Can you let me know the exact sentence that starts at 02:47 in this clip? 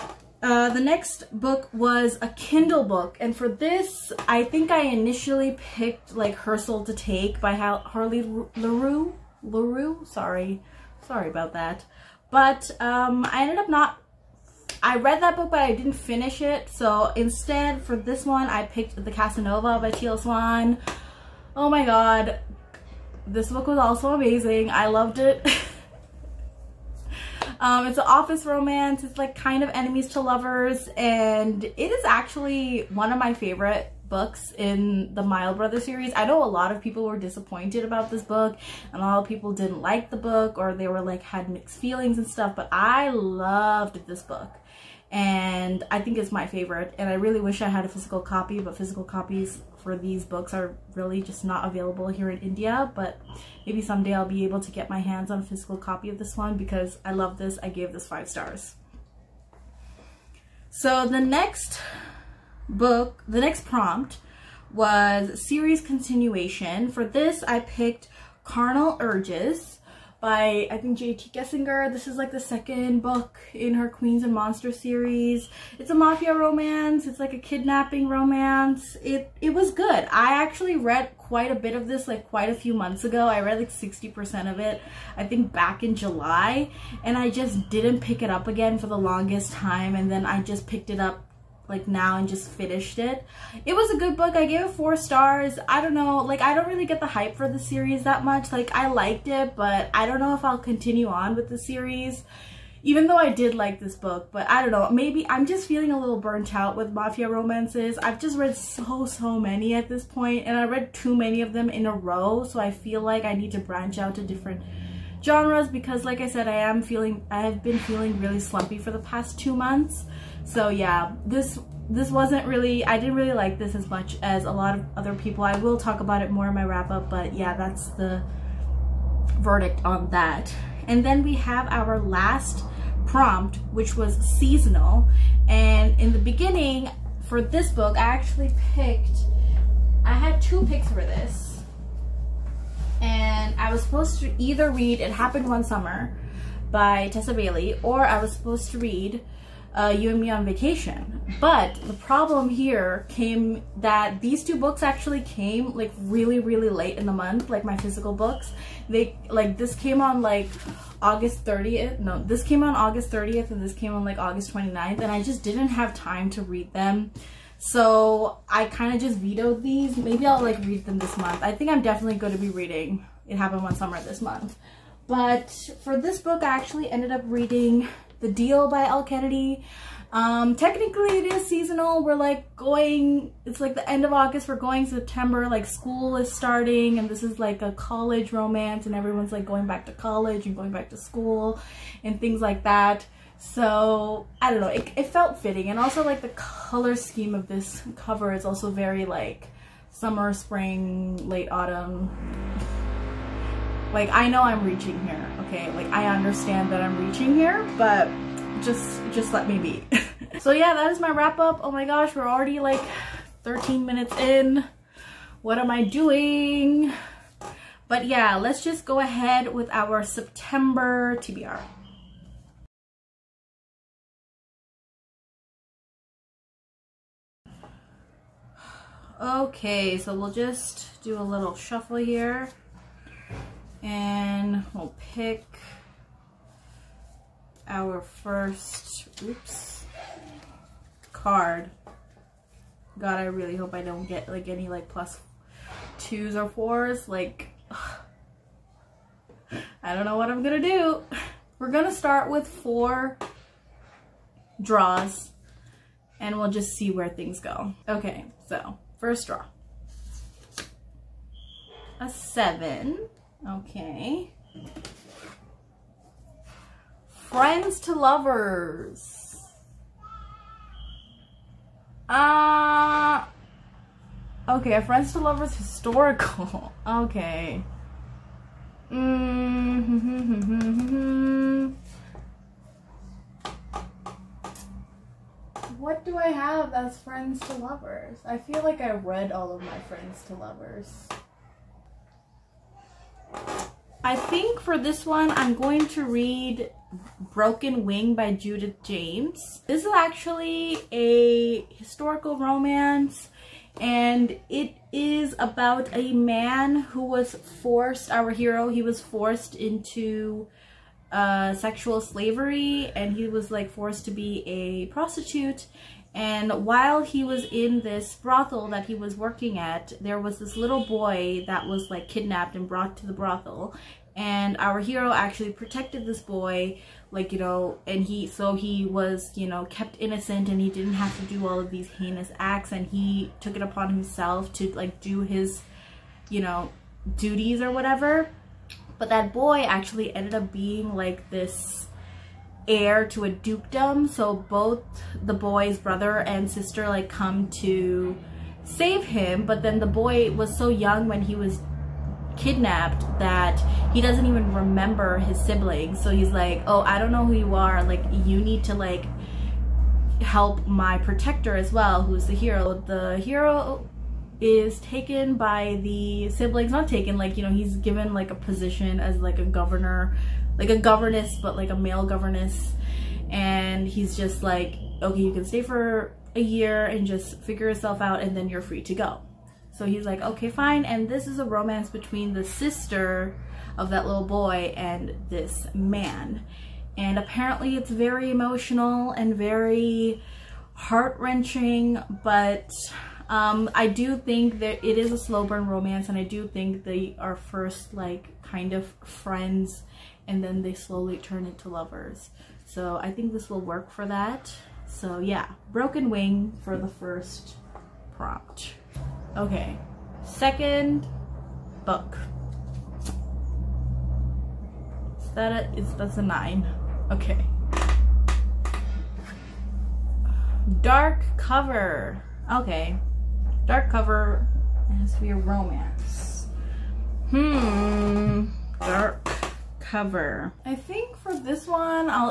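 So I kind of just vetoed these.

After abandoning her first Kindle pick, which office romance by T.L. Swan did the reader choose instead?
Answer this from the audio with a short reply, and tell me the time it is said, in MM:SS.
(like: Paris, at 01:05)
The Casanova, at 00:19.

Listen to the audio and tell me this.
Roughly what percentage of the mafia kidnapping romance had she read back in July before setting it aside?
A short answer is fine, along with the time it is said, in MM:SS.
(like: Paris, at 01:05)
60%, at 01:23.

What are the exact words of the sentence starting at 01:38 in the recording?
Like, I liked it, but I don't know if I'll continue on with the series.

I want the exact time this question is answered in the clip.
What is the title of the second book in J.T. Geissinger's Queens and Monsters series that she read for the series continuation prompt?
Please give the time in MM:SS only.
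01:08.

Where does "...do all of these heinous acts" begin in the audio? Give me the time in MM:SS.
05:31.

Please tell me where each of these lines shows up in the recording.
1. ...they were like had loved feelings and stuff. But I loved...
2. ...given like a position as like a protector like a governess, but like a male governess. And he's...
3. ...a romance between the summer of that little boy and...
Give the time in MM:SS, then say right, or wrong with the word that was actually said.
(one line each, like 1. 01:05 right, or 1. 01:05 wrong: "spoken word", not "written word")
1. 00:40 wrong: "mixed", not "loved"
2. 06:07 wrong: "governor", not "protector"
3. 06:21 wrong: "sister", not "summer".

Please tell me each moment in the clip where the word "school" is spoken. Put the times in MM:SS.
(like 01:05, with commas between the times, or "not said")
03:05, 03:10.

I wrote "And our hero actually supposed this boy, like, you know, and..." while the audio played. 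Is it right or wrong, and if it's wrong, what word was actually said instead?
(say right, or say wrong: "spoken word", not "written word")
wrong: "protected", not "supposed".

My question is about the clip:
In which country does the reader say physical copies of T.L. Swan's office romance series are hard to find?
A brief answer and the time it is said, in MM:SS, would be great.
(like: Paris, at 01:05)
India, at 00:52.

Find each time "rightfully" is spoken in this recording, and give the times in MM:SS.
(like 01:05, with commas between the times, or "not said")
not said.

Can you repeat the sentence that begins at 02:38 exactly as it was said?
They like this came on like August 30th.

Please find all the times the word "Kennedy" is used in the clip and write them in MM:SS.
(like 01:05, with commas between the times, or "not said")
02:59.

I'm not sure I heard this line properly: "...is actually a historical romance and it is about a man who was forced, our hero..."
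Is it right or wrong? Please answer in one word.
right.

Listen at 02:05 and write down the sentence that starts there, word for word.
I will talk about it more in my wrap up, but yeah, that's the verdict on that.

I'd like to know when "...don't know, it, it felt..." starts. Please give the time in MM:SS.
03:14.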